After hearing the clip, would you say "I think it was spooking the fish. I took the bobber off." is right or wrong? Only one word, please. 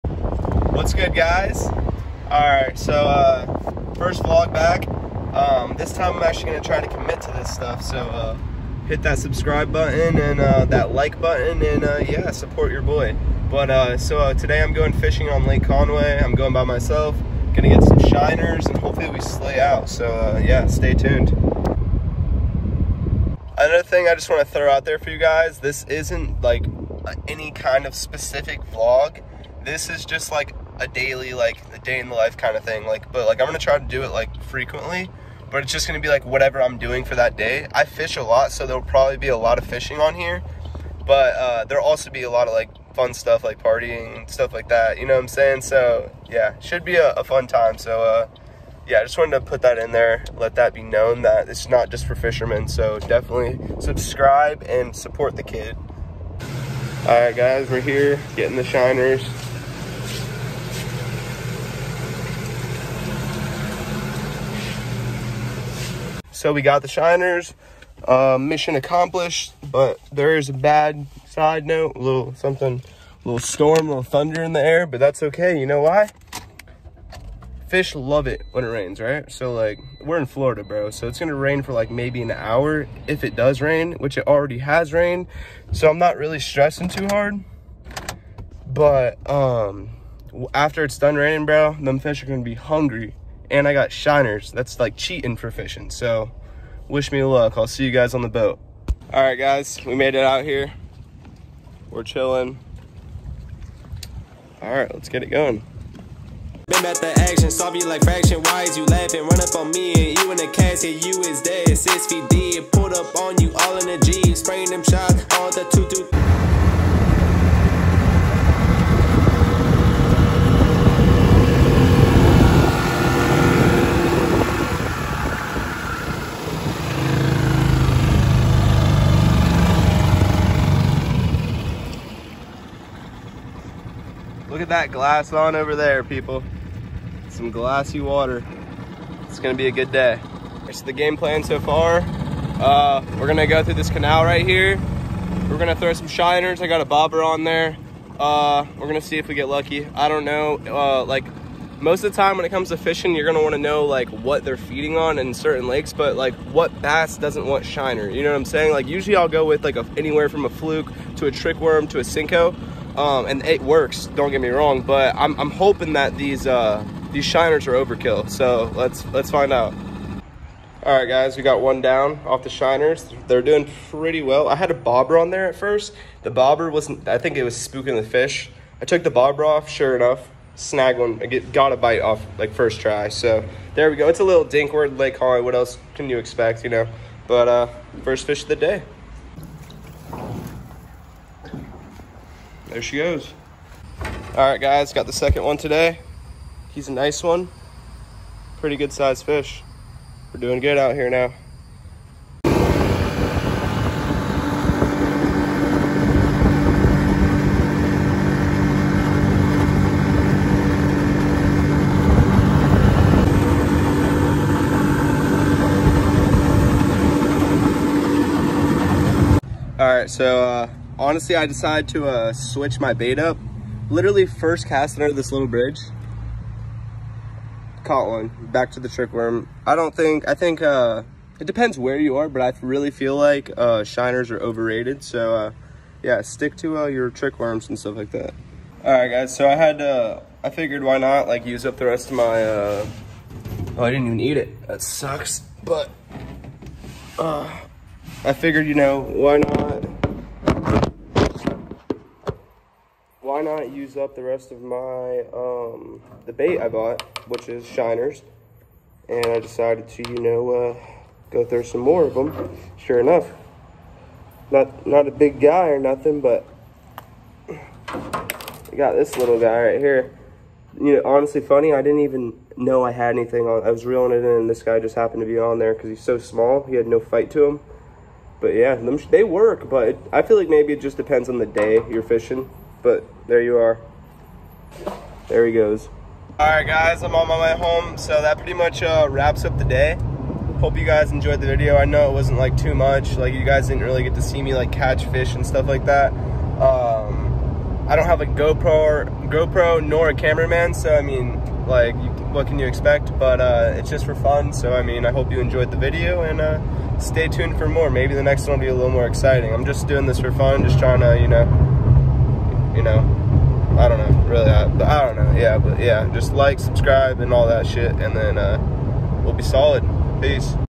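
right.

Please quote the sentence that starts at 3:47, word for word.
Caught one, back to the trick worm.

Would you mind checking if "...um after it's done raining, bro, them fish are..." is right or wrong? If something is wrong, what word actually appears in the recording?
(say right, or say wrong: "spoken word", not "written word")
right.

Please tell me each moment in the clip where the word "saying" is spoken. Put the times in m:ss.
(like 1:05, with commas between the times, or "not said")
0:45, 2:38.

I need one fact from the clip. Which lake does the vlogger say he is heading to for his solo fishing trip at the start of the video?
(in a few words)
Lake Conway.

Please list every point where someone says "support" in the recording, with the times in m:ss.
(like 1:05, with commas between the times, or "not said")
0:12, 0:54.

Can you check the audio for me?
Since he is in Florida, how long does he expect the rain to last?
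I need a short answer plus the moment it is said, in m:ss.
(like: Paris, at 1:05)
an hour, at 1:22.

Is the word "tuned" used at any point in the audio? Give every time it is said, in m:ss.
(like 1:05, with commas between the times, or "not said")
0:20, 5:07.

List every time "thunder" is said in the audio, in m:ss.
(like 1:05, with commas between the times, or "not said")
1:14.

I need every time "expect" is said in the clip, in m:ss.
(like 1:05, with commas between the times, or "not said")
3:06, 5:02.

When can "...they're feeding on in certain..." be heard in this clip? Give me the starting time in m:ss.
2:34.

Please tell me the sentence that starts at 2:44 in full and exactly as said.
Don't get me wrong, but I'm, I'm hoping that these uh, these shiners are overkill.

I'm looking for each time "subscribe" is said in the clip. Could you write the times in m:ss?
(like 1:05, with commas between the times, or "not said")
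0:09, 0:53, 5:16.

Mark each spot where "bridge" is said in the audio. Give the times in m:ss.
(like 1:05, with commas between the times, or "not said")
3:45.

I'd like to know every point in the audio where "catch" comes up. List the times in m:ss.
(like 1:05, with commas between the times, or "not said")
4:54.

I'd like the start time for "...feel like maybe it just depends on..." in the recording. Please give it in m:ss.
4:40.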